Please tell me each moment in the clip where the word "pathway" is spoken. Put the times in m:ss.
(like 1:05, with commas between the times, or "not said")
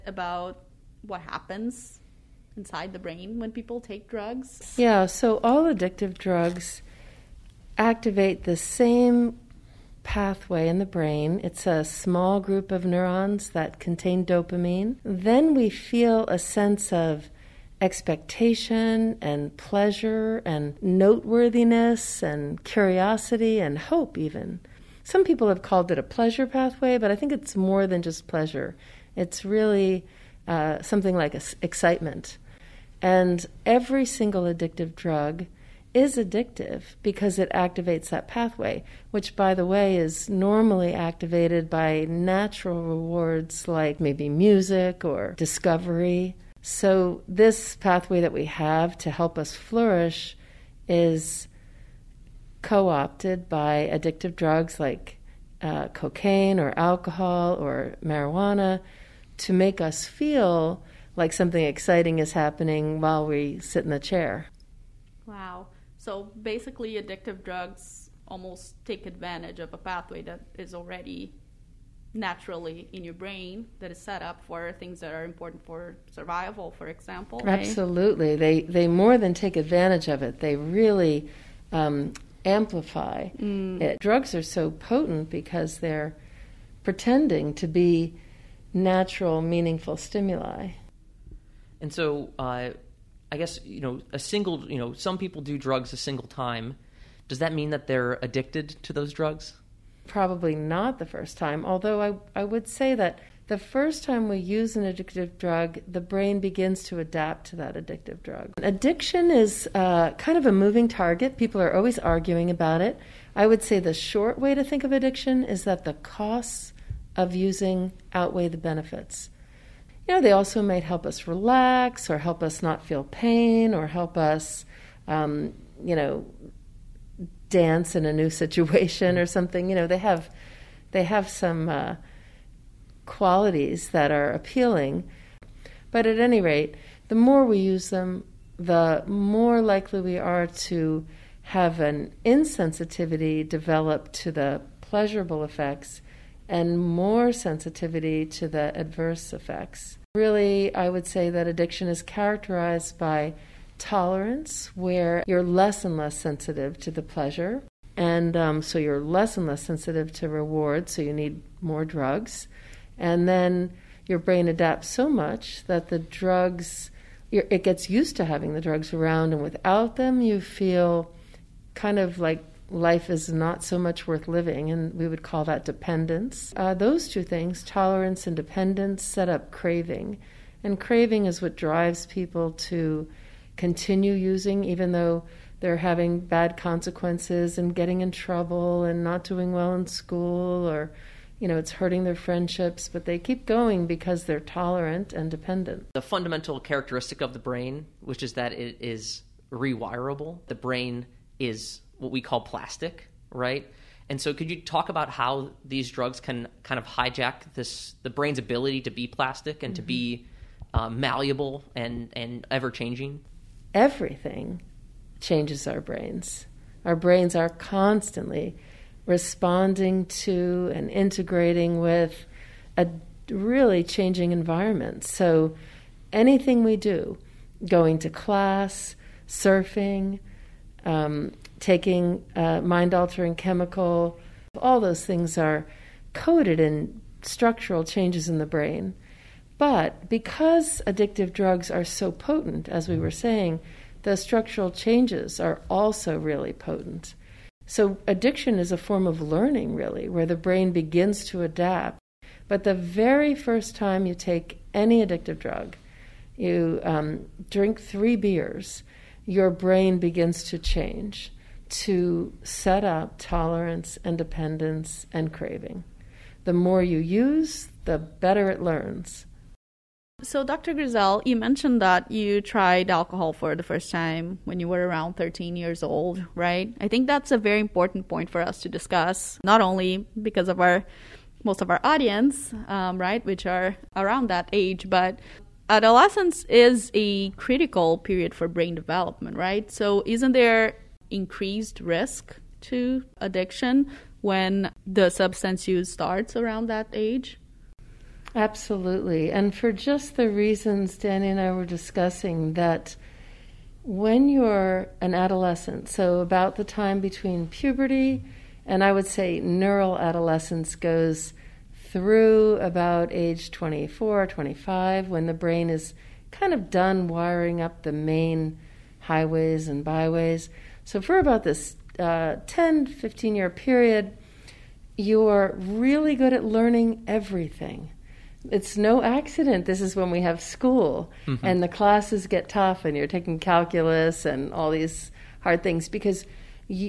0:10, 0:26, 0:38, 0:47, 1:09.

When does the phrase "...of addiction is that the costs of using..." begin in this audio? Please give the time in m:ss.
1:54.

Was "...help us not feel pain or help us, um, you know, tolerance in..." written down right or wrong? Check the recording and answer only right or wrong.
wrong.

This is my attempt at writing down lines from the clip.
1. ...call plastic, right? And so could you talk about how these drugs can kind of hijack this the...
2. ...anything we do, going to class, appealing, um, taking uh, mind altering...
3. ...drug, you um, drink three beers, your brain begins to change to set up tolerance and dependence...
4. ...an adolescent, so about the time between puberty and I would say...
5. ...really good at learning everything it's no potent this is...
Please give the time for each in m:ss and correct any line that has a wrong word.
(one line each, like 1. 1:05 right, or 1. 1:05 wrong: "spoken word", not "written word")
1. 3:22 right
2. 3:46 wrong: "surfing", not "appealing"
3. 4:15 right
4. 5:04 right
5. 5:25 wrong: "accident", not "potent".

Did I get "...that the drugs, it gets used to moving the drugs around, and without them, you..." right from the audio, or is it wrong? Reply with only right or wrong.
wrong.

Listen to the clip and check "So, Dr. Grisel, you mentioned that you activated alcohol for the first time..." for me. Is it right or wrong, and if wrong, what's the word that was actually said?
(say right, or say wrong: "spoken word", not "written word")
wrong: "tried", not "activated".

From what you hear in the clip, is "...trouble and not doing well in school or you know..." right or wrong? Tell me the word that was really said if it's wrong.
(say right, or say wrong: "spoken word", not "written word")
right.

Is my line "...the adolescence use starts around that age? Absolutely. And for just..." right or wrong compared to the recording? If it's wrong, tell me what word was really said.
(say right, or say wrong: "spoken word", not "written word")
wrong: "substance", not "adolescence".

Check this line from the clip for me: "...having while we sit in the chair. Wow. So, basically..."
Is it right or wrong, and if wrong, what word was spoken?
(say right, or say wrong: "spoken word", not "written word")
wrong: "happening", not "having".